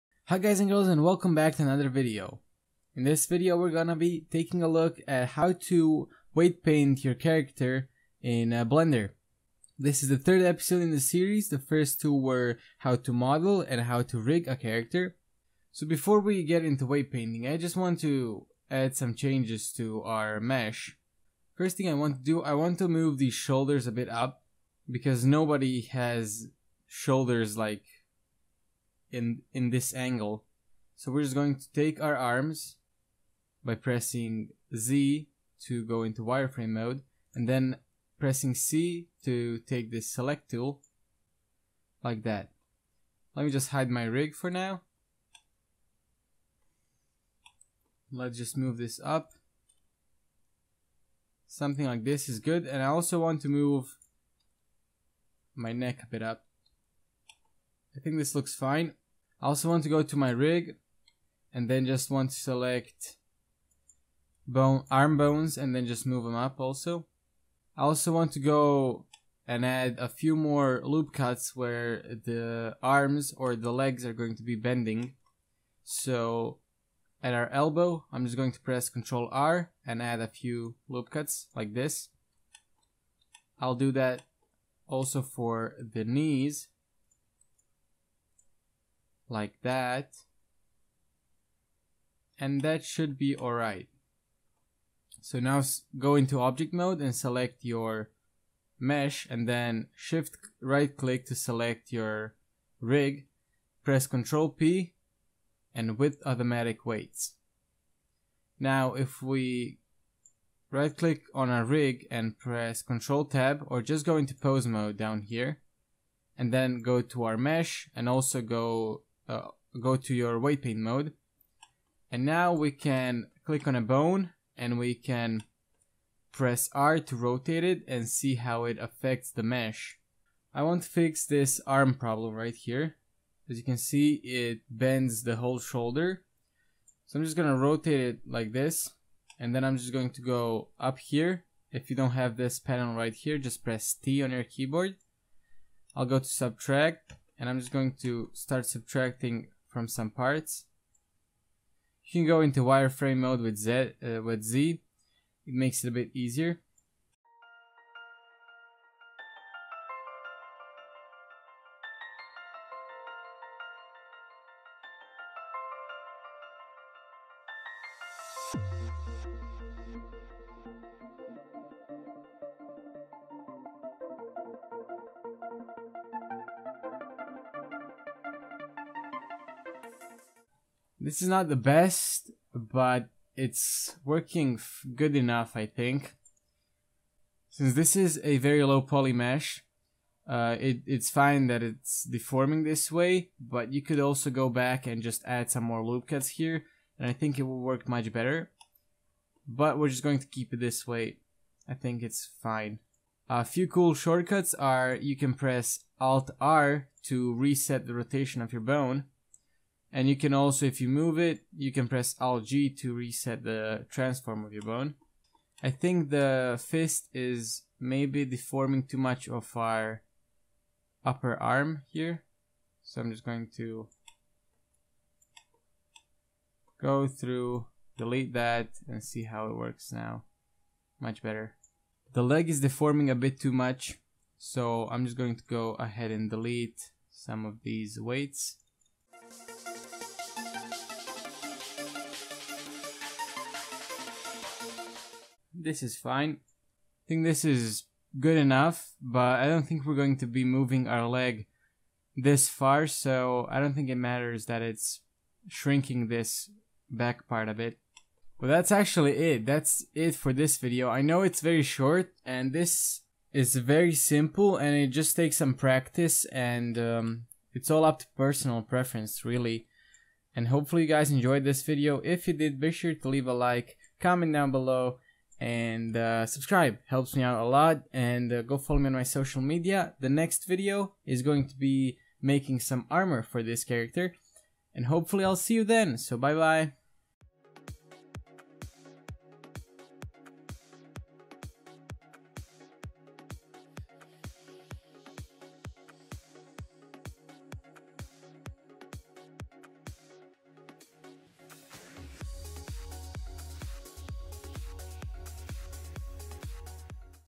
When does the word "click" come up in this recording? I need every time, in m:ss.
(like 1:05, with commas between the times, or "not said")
1:40, 1:50, 2:03.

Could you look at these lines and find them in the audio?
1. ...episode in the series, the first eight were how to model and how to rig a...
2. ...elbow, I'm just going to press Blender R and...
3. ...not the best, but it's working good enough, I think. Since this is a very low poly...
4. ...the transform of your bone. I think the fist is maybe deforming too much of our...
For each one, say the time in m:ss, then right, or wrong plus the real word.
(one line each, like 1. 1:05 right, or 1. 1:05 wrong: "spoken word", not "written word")
1. 0:10 wrong: "two", not "eight"
2. 1:17 wrong: "Ctrl", not "Blender"
3. 3:01 right
4. 3:33 right.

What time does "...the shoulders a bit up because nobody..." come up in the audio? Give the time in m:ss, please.
0:23.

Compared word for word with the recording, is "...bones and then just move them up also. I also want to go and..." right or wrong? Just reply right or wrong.
right.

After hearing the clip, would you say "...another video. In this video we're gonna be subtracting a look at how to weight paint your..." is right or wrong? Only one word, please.
wrong.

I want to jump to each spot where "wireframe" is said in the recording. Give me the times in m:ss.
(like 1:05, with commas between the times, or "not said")
0:36, 2:32.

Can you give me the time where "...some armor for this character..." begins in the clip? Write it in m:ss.
4:42.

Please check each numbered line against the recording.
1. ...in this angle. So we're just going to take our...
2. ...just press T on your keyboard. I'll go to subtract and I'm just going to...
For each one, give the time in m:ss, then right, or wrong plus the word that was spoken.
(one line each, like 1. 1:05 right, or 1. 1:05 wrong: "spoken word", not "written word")
1. 0:29 right
2. 2:23 right.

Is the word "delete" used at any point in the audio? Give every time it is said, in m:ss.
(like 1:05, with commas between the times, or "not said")
3:47, 3:56.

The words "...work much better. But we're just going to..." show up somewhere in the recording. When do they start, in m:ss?
3:17.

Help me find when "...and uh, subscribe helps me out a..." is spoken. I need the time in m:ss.
4:35.